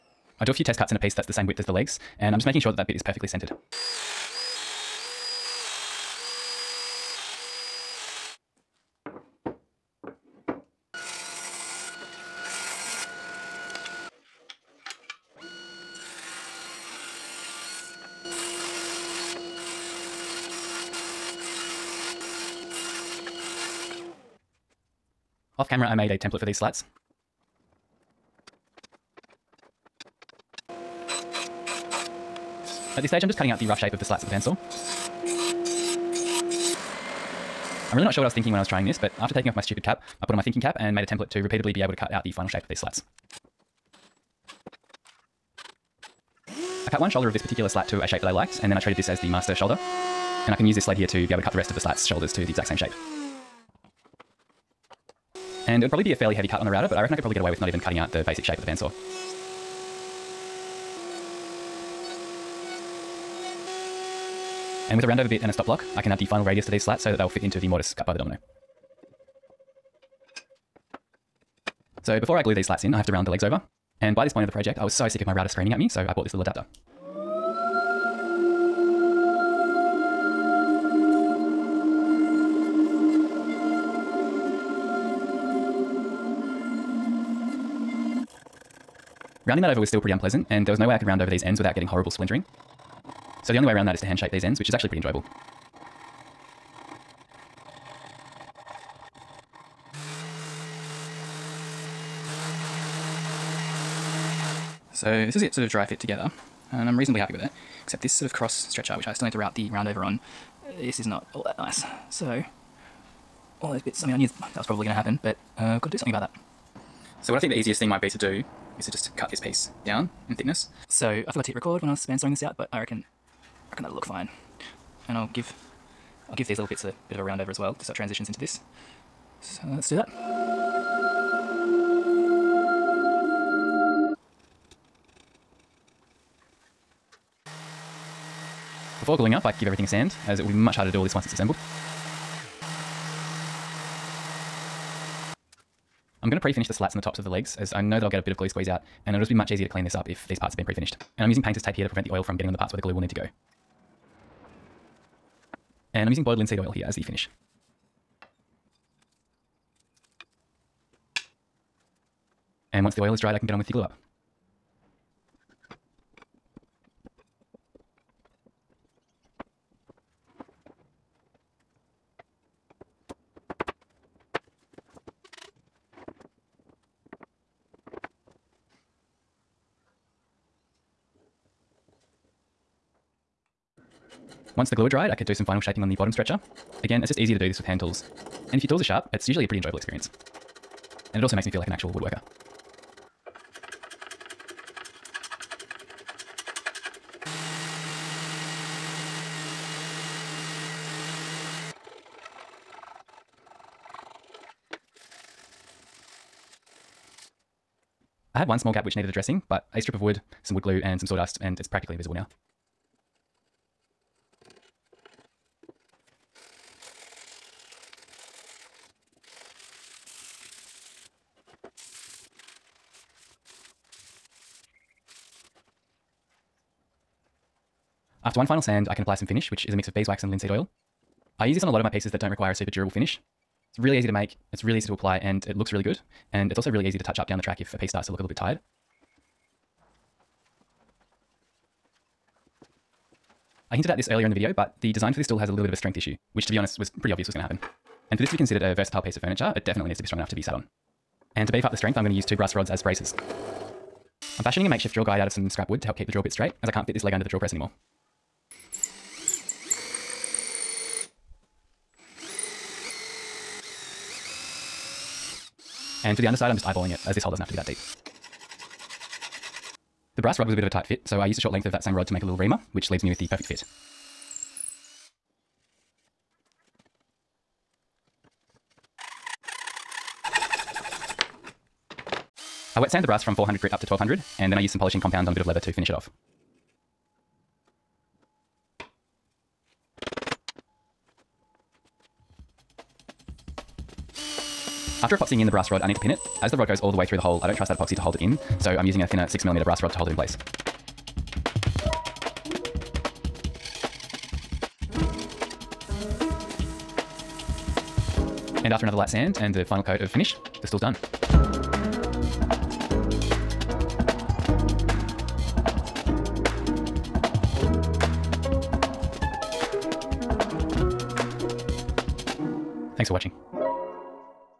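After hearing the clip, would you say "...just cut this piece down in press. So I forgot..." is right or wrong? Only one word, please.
wrong.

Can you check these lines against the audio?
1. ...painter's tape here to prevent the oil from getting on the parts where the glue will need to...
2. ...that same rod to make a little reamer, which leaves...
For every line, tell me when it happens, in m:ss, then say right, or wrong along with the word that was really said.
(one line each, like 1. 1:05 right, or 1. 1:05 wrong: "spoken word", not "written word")
1. 2:31 right
2. 4:31 right.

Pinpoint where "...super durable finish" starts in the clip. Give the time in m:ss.
3:52.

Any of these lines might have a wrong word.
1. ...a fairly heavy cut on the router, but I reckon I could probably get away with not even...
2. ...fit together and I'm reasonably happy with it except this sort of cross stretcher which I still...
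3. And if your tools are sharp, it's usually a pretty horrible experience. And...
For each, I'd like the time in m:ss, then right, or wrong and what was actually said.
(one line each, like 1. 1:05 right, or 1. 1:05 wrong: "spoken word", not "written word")
1. 0:56 right
2. 1:45 right
3. 3:08 wrong: "enjoyable", not "horrible".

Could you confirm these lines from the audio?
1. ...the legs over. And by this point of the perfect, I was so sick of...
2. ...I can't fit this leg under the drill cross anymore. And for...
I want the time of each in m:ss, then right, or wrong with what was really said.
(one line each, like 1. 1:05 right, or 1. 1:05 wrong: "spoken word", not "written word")
1. 1:13 wrong: "project", not "perfect"
2. 4:16 wrong: "press", not "cross".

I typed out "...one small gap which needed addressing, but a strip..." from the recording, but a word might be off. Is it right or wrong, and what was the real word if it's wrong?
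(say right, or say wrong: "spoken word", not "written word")
right.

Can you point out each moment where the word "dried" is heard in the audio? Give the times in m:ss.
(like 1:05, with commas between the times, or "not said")
2:43, 3:04.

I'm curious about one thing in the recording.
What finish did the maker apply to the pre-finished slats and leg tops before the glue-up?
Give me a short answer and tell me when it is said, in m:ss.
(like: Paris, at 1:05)
boiled linseed oil, at 2:36.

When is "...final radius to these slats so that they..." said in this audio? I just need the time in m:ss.
1:06.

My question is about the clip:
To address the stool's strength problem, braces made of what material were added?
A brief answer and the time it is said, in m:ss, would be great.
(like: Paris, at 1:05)
brass rods, at 4:12.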